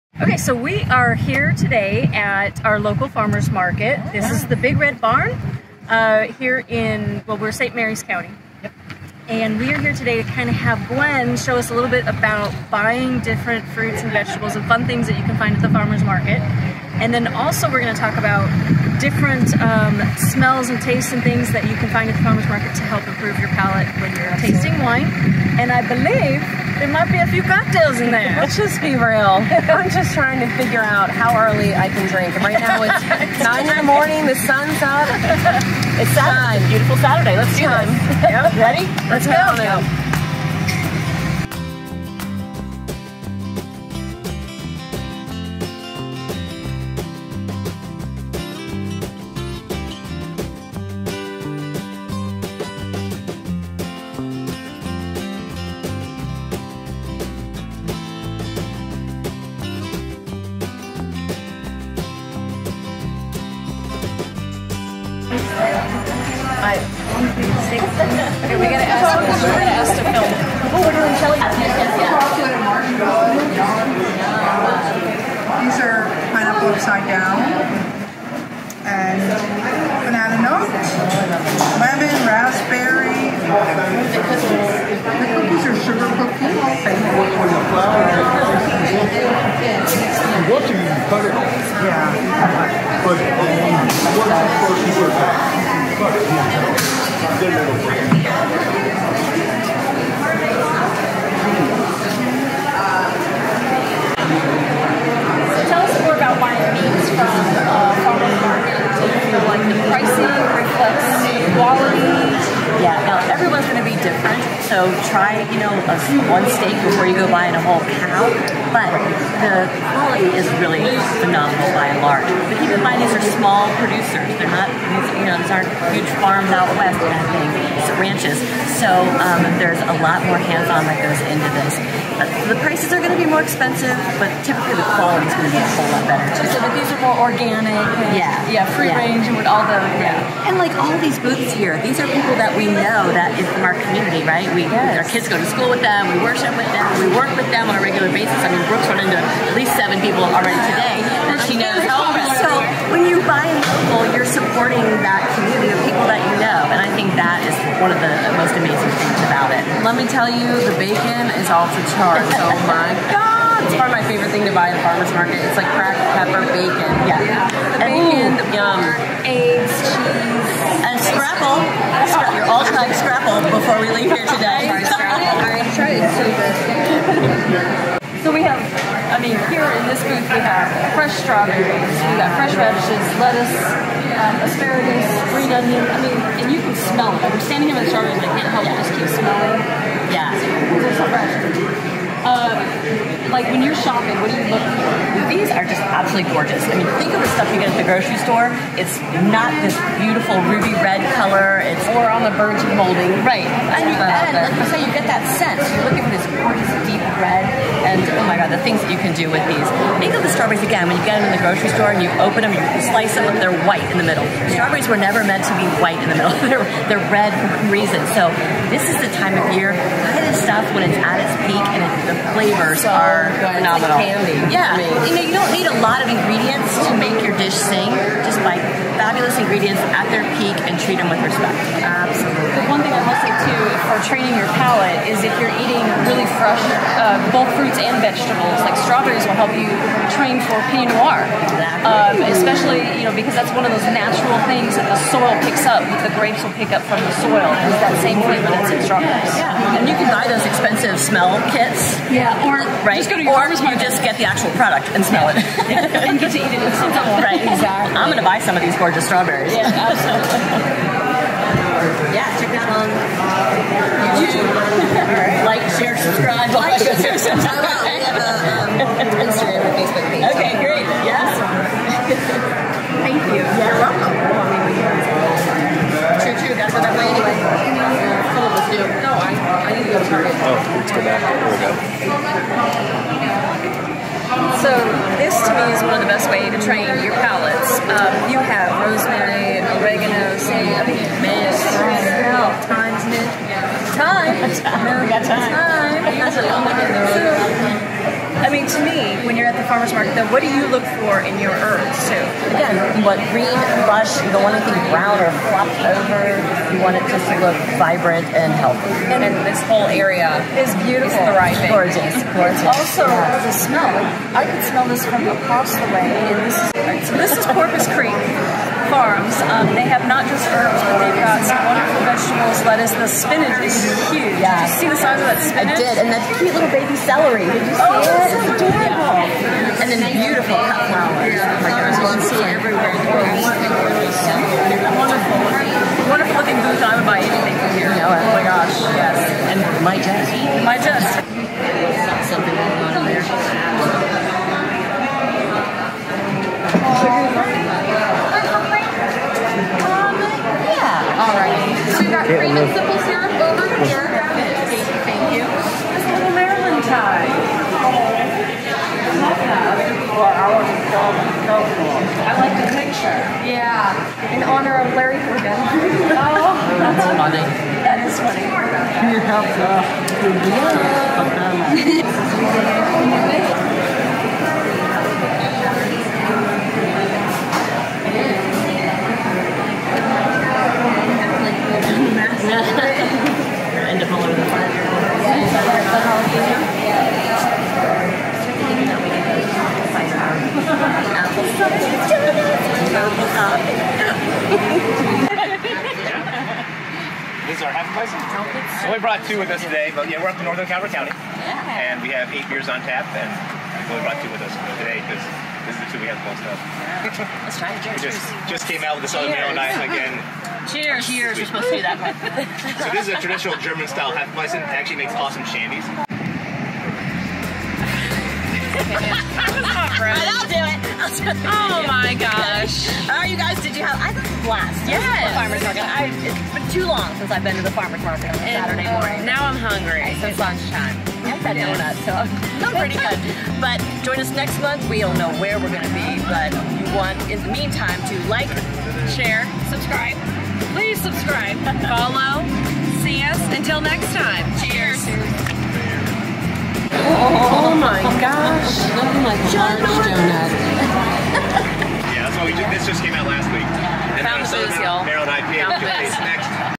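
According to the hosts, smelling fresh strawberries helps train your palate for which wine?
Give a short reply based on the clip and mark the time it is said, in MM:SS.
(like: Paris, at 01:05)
Pinot Noir, at 04:00.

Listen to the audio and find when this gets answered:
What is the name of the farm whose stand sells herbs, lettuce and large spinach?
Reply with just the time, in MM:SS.
05:17.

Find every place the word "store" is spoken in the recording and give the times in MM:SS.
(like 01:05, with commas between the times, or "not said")
03:18, 03:31.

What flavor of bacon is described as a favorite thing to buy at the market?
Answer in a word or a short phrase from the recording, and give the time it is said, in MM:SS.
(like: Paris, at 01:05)
Cracked pepper, at 02:45.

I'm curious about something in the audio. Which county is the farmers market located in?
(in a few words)
St. Mary's County.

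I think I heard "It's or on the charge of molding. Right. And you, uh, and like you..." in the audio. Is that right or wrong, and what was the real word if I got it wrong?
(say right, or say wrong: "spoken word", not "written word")
wrong: "verge", not "charge".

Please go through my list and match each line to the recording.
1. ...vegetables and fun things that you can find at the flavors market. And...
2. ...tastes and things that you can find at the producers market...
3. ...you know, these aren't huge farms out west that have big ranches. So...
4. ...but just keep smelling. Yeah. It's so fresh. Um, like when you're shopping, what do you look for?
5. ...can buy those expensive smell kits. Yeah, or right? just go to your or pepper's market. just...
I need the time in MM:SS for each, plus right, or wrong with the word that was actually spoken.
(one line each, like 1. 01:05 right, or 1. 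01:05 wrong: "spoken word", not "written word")
1. 00:14 wrong: "farmers", not "flavors"
2. 00:20 wrong: "farmers", not "producers"
3. 02:05 right
4. 03:08 right
5. 04:09 wrong: "farmer", not "pepper".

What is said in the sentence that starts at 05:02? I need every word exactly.
Again, what green, lush, you don't want anything brown or flopped over.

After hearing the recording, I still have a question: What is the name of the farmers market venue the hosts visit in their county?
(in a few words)
Big Red Barn.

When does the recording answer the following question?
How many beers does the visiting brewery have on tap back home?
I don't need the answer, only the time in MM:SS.
06:42.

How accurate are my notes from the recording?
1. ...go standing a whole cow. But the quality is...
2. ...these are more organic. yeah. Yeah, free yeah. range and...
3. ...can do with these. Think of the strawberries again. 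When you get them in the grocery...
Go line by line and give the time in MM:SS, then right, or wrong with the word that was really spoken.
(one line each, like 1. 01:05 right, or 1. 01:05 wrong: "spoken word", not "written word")
1. 01:57 wrong: "buying", not "standing"
2. 02:16 right
3. 03:29 right.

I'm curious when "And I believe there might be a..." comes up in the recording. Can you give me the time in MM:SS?
00:25.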